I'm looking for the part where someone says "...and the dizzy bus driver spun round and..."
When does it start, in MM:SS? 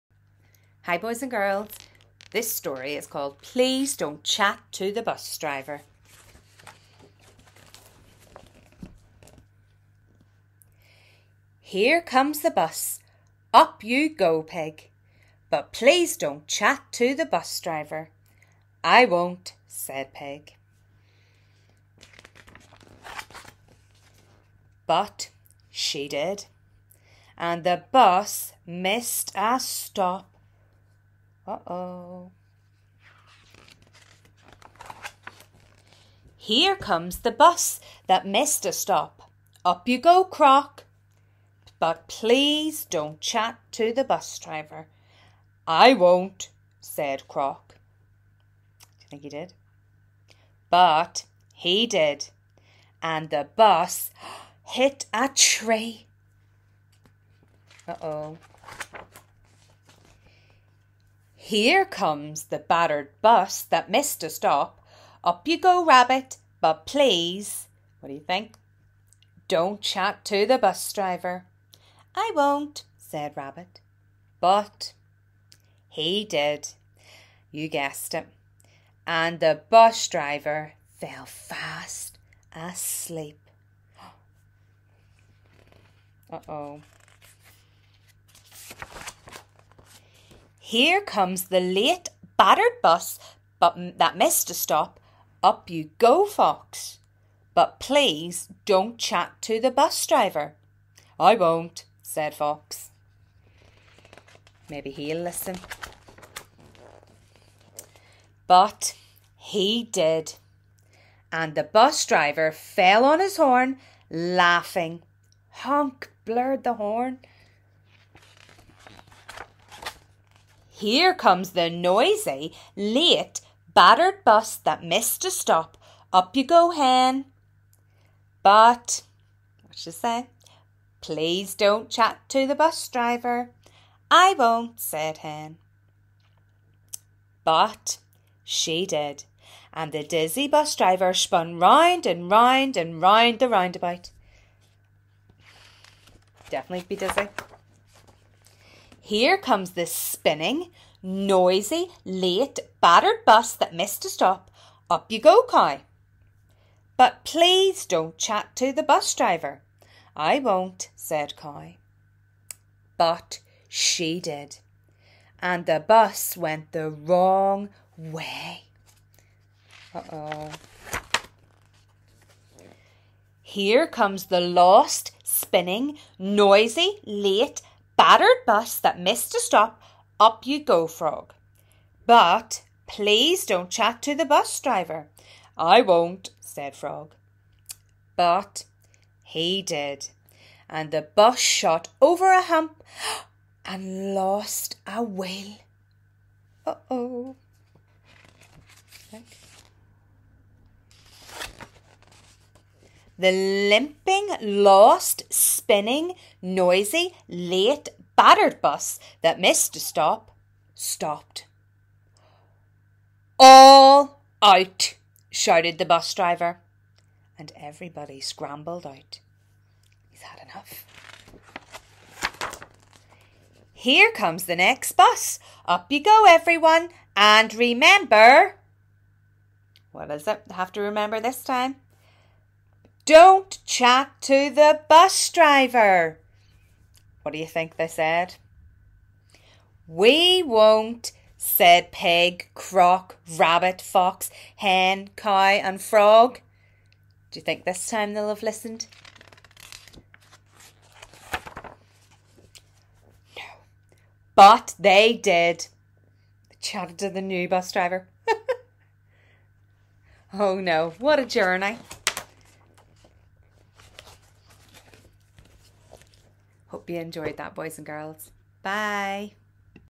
02:19.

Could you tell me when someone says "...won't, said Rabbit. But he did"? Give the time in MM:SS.
01:12.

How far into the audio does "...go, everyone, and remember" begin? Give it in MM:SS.
03:46.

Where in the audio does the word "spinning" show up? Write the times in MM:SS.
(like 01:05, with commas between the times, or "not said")
02:29, 02:55, 03:25.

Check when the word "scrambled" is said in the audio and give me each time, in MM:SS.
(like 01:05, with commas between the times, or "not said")
03:38.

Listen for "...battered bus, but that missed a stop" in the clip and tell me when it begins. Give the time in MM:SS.
01:32.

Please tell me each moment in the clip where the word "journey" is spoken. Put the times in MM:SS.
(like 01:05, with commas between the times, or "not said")
04:21.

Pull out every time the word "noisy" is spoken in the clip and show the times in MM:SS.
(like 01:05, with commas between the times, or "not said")
02:01, 02:31, 02:56, 03:26.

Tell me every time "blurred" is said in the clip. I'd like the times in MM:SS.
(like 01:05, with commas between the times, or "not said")
01:56.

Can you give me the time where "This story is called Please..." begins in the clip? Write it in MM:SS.
00:02.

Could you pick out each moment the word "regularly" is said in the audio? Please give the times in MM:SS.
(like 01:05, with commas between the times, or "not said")
not said.